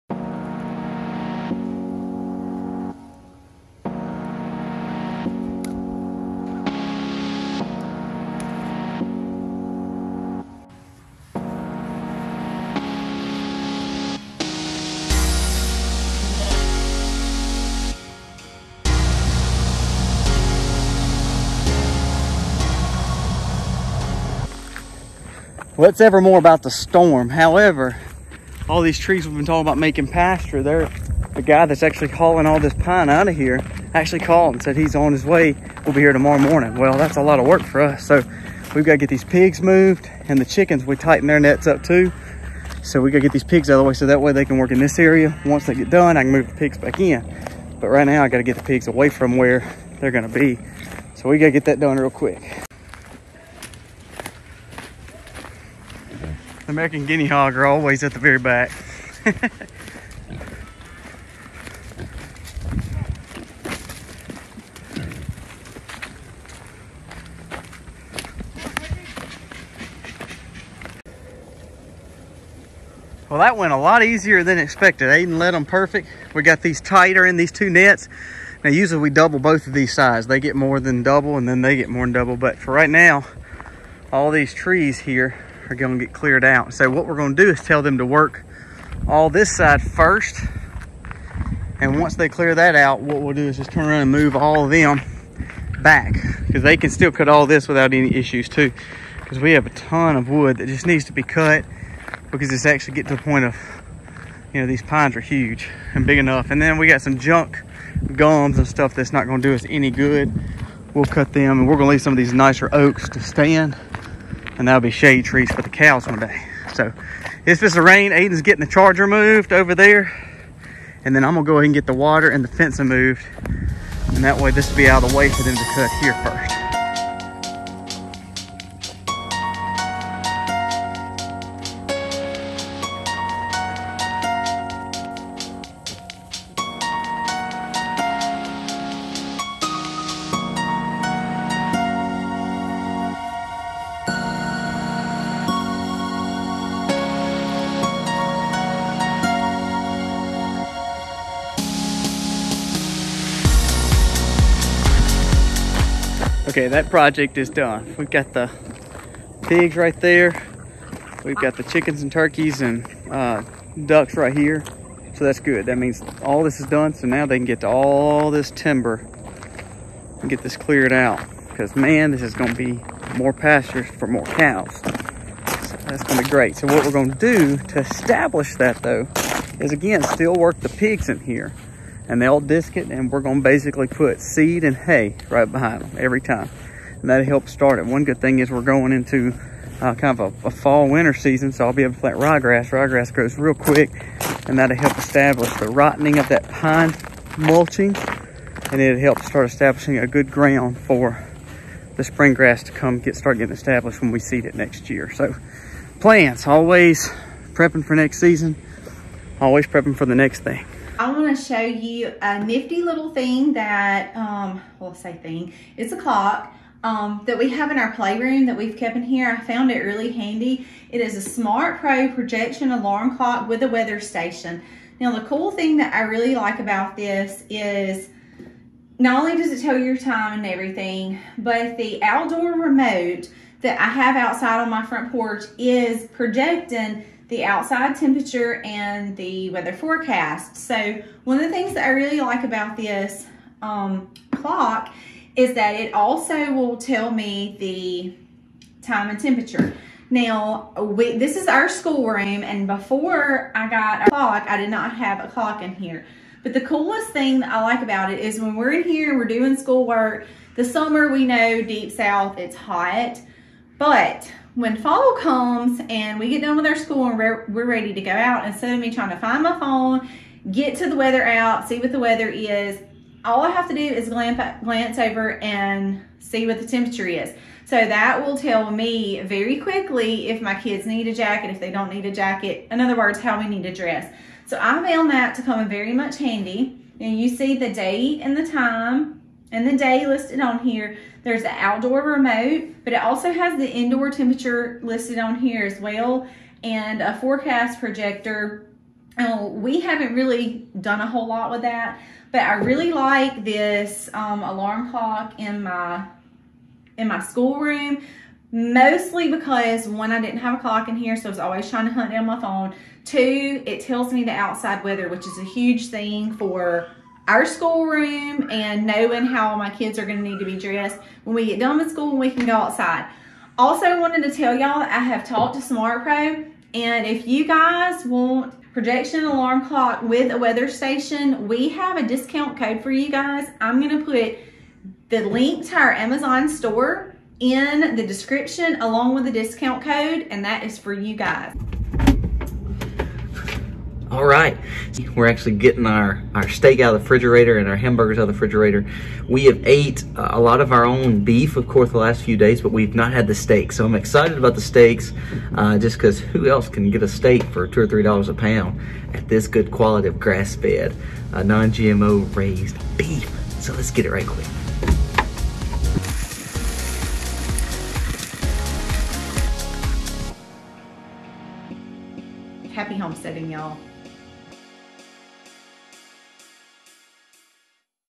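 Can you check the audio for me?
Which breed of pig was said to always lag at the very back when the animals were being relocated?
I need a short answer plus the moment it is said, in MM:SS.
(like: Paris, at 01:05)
American guinea hog, at 00:56.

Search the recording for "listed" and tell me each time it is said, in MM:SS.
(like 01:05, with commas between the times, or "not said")
04:50, 04:54.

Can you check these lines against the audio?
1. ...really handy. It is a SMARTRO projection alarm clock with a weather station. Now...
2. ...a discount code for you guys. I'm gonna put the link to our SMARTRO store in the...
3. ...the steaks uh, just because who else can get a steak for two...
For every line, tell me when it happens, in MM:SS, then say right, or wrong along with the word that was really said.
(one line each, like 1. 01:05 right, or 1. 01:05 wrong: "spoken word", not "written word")
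1. 03:39 right
2. 05:31 wrong: "Amazon", not "SMARTRO"
3. 05:54 right.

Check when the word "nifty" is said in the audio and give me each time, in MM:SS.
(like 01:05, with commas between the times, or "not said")
03:32.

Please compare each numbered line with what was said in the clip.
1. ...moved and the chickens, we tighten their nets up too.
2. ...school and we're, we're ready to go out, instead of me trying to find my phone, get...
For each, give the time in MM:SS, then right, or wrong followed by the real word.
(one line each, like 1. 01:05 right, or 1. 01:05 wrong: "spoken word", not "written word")
1. 00:39 right
2. 04:26 right.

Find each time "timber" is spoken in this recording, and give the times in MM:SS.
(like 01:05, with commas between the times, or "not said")
02:48.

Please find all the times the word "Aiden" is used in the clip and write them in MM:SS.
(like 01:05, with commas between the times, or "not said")
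01:15, 01:58.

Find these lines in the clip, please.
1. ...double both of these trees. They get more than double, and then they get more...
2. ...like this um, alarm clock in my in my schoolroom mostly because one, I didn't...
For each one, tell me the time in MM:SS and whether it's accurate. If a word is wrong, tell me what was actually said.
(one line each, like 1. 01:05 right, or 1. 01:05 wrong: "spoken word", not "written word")
1. 01:19 wrong: "sides", not "trees"
2. 05:02 right.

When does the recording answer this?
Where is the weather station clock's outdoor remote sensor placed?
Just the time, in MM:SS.
03:54.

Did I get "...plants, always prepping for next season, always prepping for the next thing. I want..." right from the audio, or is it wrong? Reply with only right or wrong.
right.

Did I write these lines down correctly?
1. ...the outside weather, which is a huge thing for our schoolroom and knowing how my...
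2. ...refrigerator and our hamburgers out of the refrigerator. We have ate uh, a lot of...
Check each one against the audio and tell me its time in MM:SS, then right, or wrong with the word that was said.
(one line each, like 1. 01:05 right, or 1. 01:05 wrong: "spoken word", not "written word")
1. 05:14 right
2. 05:47 right.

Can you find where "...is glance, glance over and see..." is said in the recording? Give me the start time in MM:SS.
04:33.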